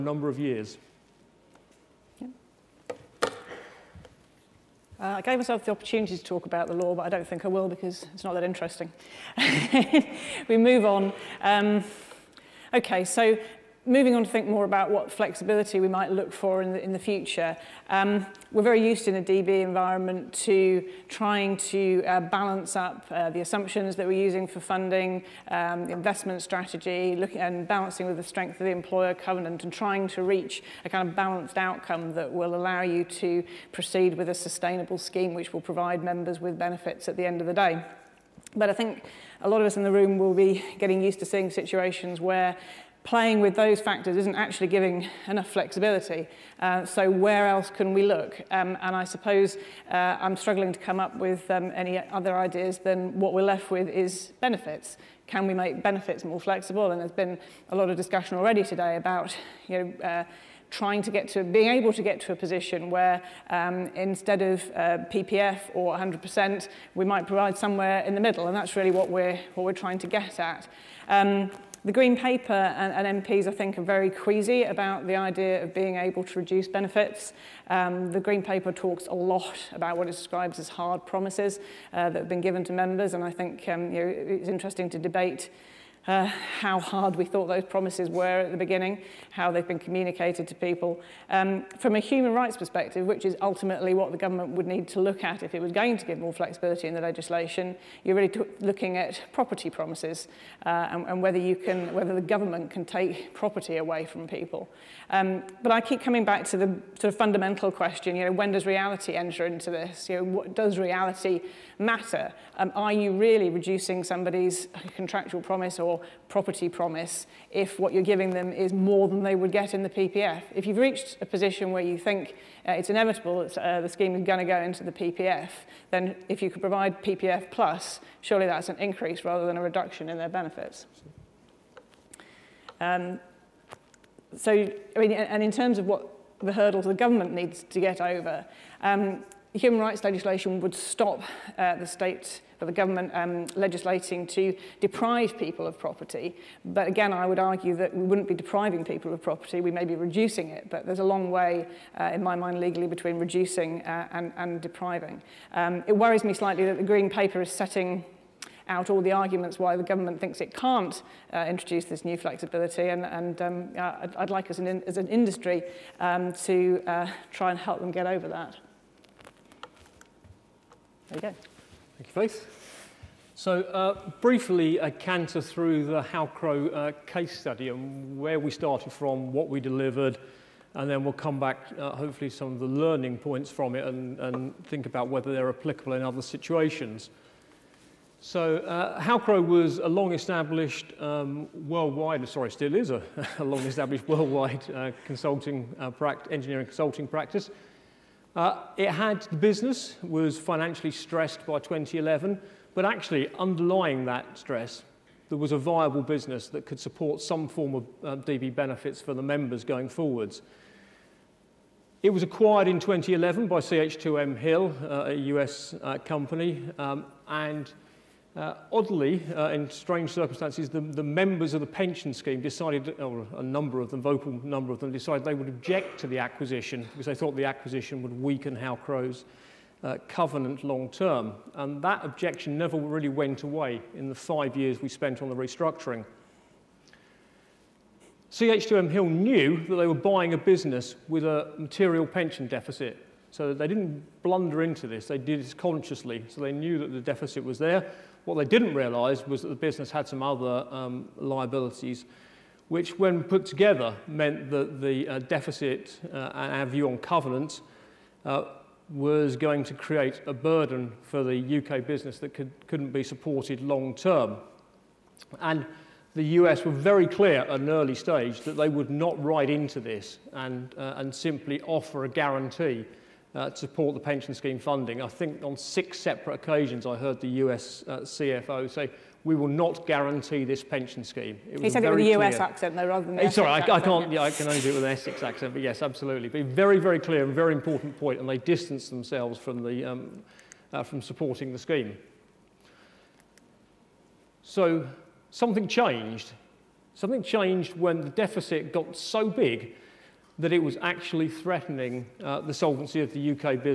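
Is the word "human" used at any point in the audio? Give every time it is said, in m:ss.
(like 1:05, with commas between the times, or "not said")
1:31, 2:19.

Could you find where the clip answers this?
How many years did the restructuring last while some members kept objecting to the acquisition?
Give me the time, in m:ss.
3:54.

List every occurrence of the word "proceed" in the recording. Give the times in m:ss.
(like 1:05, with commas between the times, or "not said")
0:33.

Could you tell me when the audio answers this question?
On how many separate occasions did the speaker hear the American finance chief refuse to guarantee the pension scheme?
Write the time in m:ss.
4:35.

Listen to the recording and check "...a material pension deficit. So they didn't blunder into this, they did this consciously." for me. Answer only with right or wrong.
right.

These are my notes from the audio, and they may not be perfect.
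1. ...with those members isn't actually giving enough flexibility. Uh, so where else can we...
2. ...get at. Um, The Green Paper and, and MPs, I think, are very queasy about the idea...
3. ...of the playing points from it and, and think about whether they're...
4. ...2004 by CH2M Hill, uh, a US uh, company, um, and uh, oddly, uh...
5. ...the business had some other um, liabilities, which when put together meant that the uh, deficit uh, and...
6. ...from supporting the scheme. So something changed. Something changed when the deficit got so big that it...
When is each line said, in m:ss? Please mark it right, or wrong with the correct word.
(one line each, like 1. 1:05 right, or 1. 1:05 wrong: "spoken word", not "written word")
1. 0:43 wrong: "factors", not "members"
2. 1:10 right
3. 3:02 wrong: "learning", not "playing"
4. 3:32 wrong: "2011", not "2004"
5. 4:09 right
6. 4:50 right.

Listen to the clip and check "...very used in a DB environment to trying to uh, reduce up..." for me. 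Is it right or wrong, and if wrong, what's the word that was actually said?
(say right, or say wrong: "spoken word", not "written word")
wrong: "balance", not "reduce".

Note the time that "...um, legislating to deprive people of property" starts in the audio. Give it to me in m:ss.
2:23.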